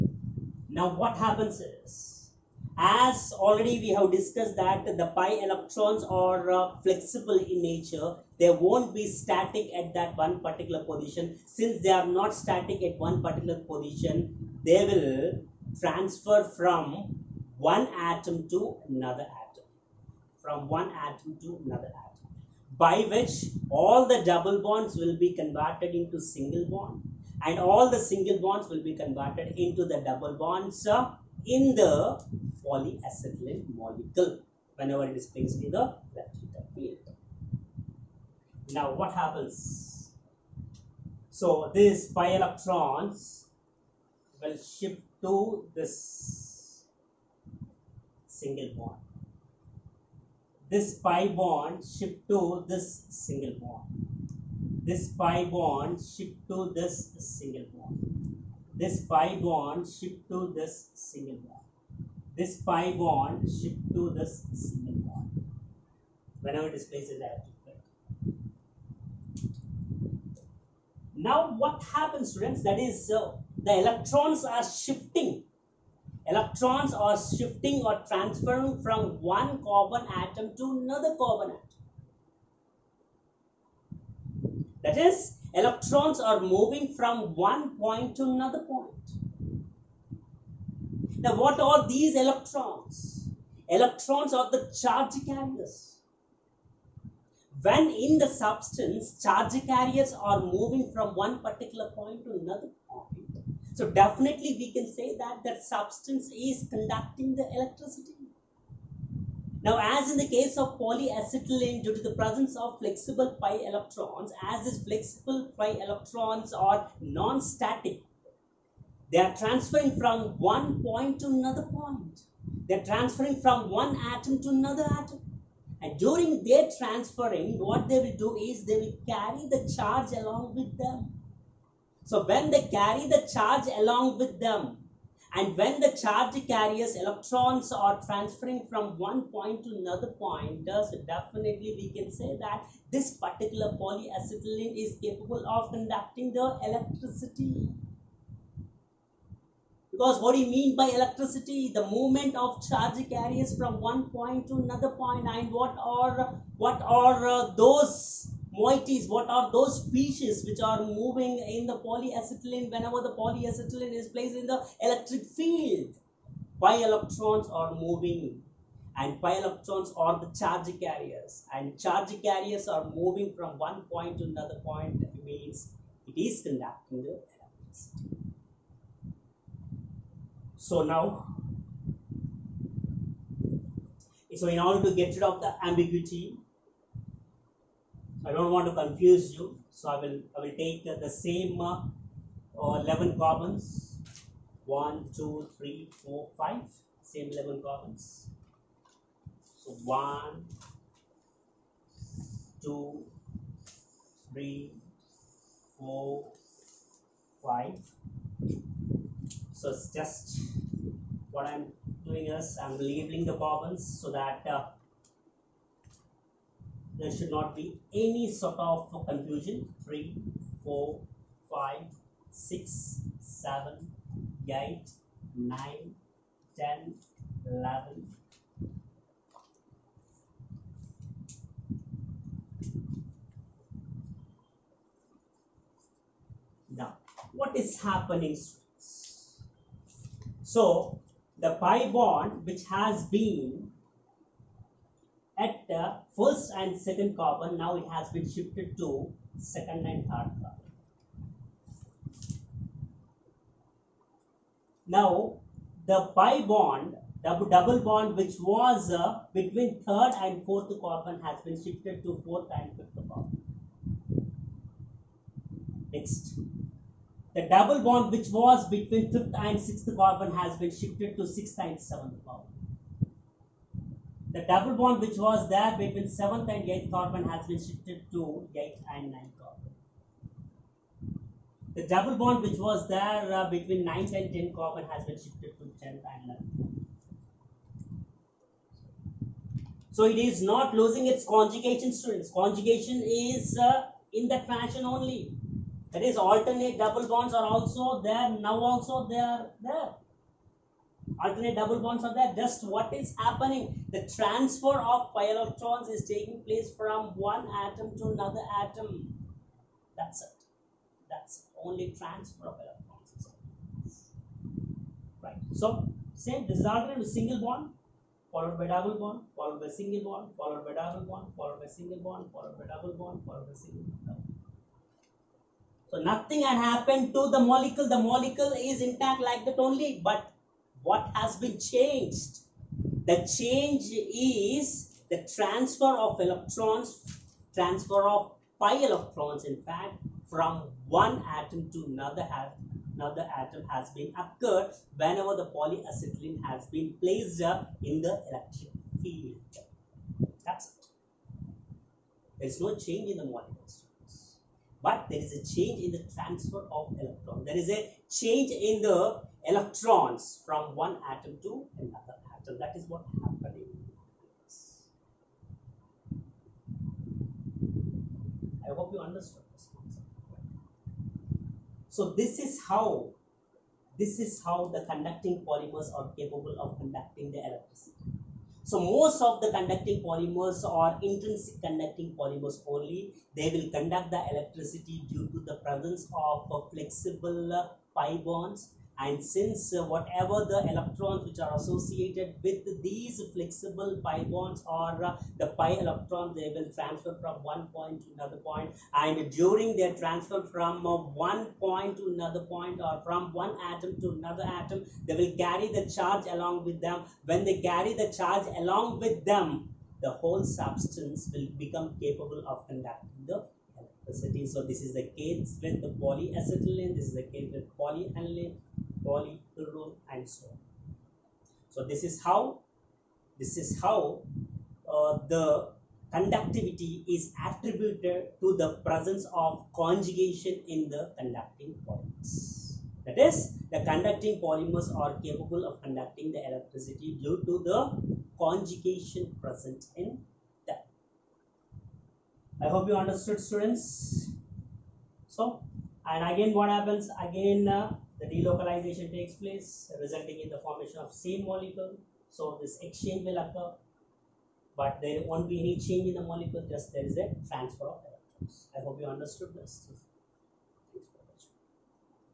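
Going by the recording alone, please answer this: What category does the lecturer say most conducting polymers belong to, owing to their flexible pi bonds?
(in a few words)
intrinsic conducting polymers.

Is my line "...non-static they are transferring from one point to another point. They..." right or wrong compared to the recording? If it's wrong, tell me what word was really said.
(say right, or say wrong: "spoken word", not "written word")
right.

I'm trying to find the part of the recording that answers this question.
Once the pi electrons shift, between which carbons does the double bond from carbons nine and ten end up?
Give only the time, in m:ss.
4:45.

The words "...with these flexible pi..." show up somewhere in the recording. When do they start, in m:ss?
6:32.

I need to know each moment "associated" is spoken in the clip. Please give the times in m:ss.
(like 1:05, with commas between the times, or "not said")
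6:31.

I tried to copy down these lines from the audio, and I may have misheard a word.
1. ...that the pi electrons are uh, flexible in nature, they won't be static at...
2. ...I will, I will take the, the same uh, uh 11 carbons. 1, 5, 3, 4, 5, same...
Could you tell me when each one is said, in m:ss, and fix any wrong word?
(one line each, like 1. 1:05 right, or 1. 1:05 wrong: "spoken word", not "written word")
1. 0:04 right
2. 3:09 wrong: "2", not "5".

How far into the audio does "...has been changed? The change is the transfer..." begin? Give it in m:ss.
5:31.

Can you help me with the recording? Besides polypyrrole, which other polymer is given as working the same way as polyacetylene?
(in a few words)
polyaniline.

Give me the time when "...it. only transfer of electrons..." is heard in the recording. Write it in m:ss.
5:11.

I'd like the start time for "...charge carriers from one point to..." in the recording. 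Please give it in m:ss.
2:32.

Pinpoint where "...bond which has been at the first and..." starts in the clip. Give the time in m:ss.
4:01.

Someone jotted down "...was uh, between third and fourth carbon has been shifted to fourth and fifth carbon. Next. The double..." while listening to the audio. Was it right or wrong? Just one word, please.
right.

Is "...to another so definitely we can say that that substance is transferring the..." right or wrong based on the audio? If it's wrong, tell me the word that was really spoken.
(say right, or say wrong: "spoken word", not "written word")
wrong: "conducting", not "transferring".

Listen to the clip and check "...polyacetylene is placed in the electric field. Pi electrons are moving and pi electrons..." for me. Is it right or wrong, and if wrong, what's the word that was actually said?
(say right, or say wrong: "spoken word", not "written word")
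right.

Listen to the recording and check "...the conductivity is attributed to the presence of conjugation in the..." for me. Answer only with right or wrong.
right.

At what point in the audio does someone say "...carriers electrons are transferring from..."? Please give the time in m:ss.
2:16.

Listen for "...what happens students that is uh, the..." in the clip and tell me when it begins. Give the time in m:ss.
1:11.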